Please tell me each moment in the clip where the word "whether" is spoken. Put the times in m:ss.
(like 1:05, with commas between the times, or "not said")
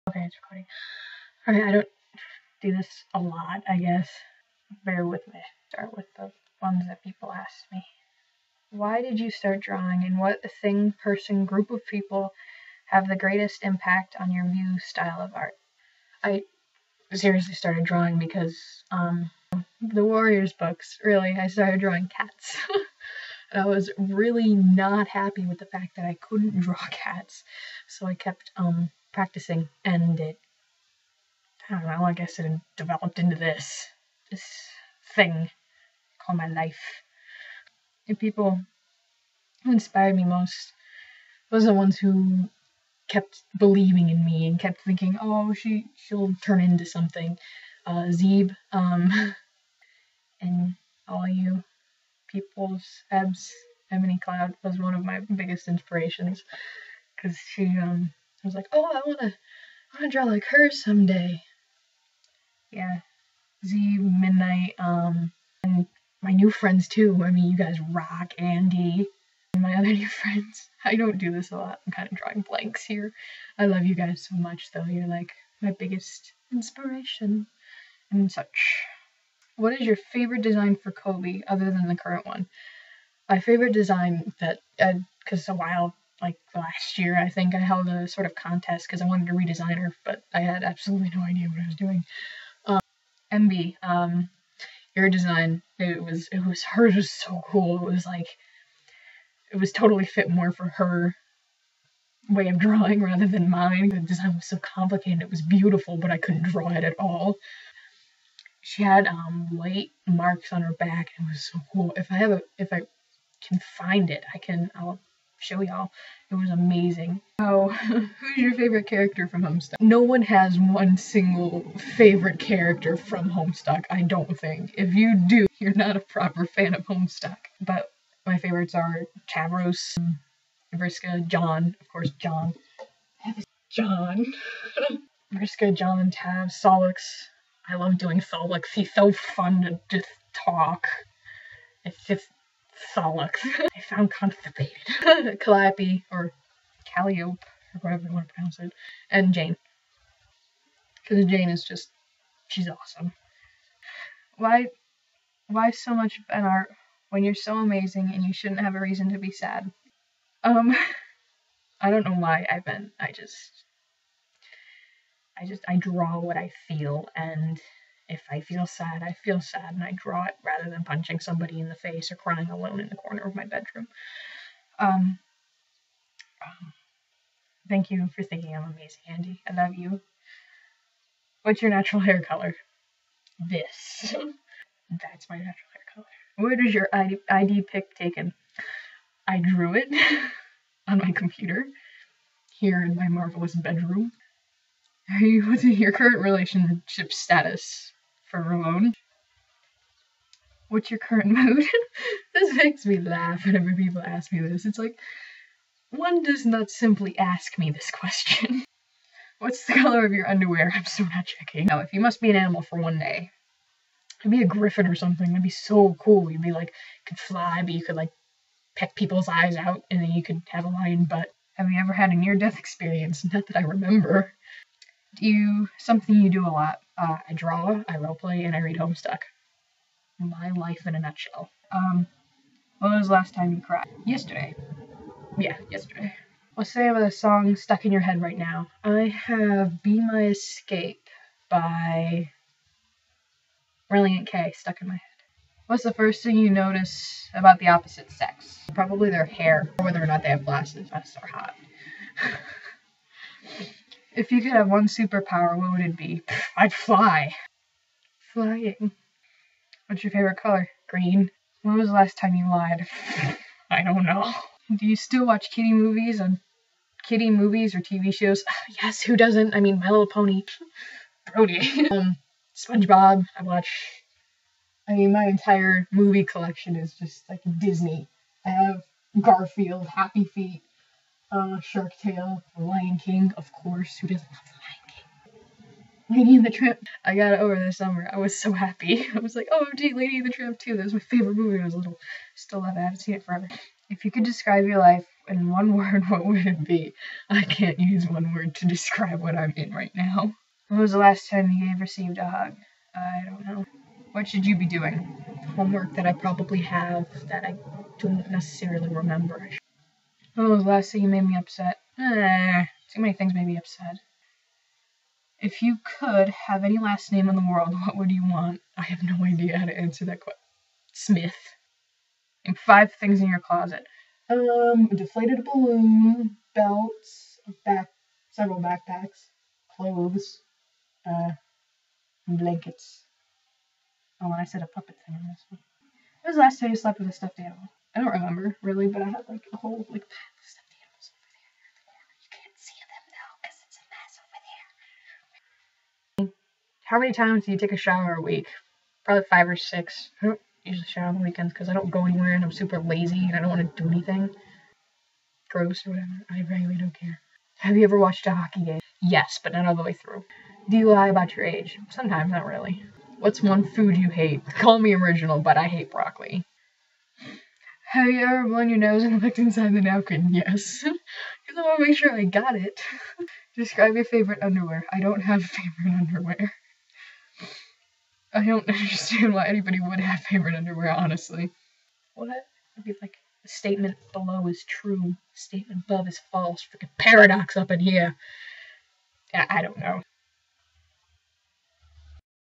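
4:09.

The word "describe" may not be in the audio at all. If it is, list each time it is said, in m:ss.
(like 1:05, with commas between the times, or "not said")
4:54, 4:58, 6:13.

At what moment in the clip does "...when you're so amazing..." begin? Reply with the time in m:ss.
2:37.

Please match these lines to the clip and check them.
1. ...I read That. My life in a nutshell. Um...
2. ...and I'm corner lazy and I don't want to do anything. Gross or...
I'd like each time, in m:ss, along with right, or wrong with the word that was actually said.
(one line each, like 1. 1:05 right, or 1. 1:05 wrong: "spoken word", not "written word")
1. 3:48 wrong: "Homestuck", not "That"
2. 5:52 wrong: "super", not "corner".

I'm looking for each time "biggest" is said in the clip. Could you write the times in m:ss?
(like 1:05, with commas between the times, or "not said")
0:55, 1:15.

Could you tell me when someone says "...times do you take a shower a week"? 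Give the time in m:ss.
5:47.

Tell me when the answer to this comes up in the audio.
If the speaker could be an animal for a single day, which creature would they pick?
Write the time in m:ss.
3:34.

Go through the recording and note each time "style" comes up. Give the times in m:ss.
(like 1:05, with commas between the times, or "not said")
0:14.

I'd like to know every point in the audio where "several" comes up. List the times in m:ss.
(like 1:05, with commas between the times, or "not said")
5:28.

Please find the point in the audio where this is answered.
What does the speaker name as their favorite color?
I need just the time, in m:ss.
4:20.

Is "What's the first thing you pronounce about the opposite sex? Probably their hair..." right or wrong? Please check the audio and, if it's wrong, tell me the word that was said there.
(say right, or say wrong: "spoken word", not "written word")
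wrong: "notice", not "pronounce".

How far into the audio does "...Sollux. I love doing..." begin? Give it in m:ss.
2:16.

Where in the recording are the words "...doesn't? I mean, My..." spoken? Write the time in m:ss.
4:29.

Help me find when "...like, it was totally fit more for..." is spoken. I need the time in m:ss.
1:38.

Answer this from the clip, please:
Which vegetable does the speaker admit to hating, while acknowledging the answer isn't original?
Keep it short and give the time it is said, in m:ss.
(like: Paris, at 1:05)
Broccoli, at 6:05.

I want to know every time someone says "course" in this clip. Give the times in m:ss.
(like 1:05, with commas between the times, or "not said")
2:11, 4:43.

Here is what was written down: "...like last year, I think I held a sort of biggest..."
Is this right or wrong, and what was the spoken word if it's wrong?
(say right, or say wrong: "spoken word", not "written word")
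wrong: "contest", not "biggest".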